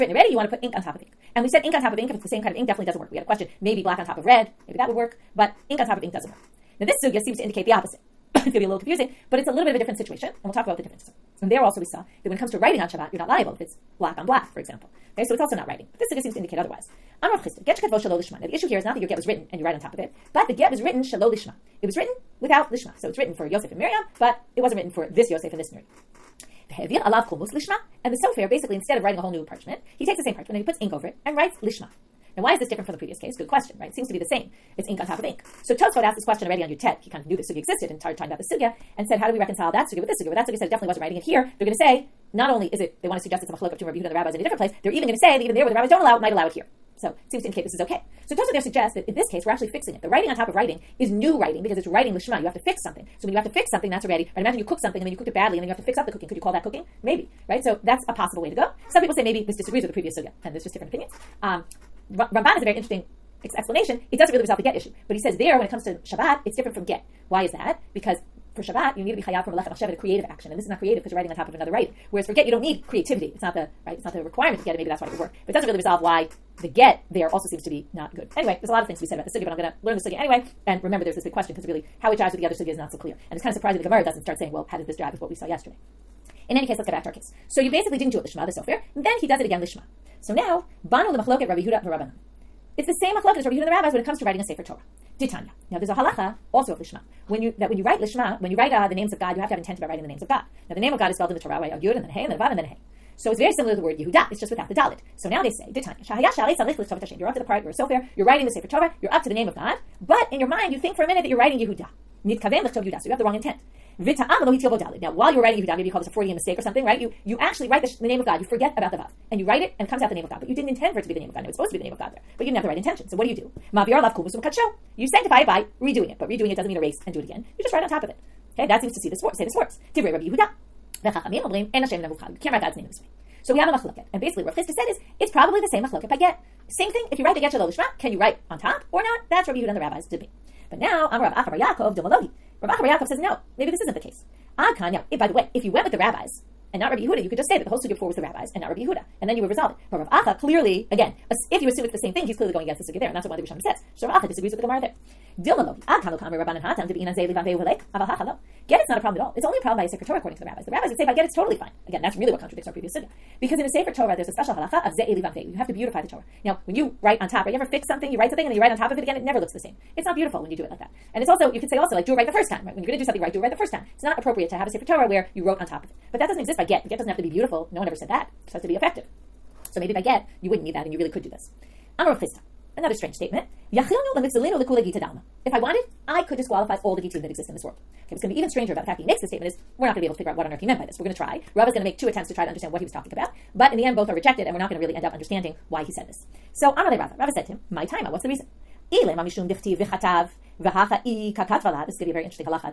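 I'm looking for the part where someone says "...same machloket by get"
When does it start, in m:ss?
2:15.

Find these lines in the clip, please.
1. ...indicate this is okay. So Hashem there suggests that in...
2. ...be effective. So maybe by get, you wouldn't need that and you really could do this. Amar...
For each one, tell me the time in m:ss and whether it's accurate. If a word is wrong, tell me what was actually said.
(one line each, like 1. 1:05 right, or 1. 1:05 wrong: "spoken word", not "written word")
1. 0:47 wrong: "Tosa", not "Hashem"
2. 2:58 right.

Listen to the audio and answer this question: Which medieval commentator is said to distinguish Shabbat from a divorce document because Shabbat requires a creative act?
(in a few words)
Ramban.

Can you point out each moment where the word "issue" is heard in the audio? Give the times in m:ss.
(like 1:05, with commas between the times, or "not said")
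0:18, 1:04.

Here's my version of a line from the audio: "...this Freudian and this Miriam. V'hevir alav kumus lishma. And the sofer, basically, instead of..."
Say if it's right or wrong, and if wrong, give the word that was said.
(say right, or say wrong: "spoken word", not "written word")
wrong: "Yosef", not "Freudian".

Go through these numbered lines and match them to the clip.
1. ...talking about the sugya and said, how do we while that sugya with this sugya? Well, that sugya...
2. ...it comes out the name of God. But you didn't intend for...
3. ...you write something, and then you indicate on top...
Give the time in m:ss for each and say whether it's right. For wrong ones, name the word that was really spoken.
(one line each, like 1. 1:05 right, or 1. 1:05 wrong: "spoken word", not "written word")
1. 0:38 wrong: "reconcile", not "while"
2. 1:59 right
3. 2:48 wrong: "write", not "indicate".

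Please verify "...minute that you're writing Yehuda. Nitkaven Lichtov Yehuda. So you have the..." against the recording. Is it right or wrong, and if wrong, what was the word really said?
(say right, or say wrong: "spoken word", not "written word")
right.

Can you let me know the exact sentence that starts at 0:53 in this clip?
So when you have to fix something, that's already, right?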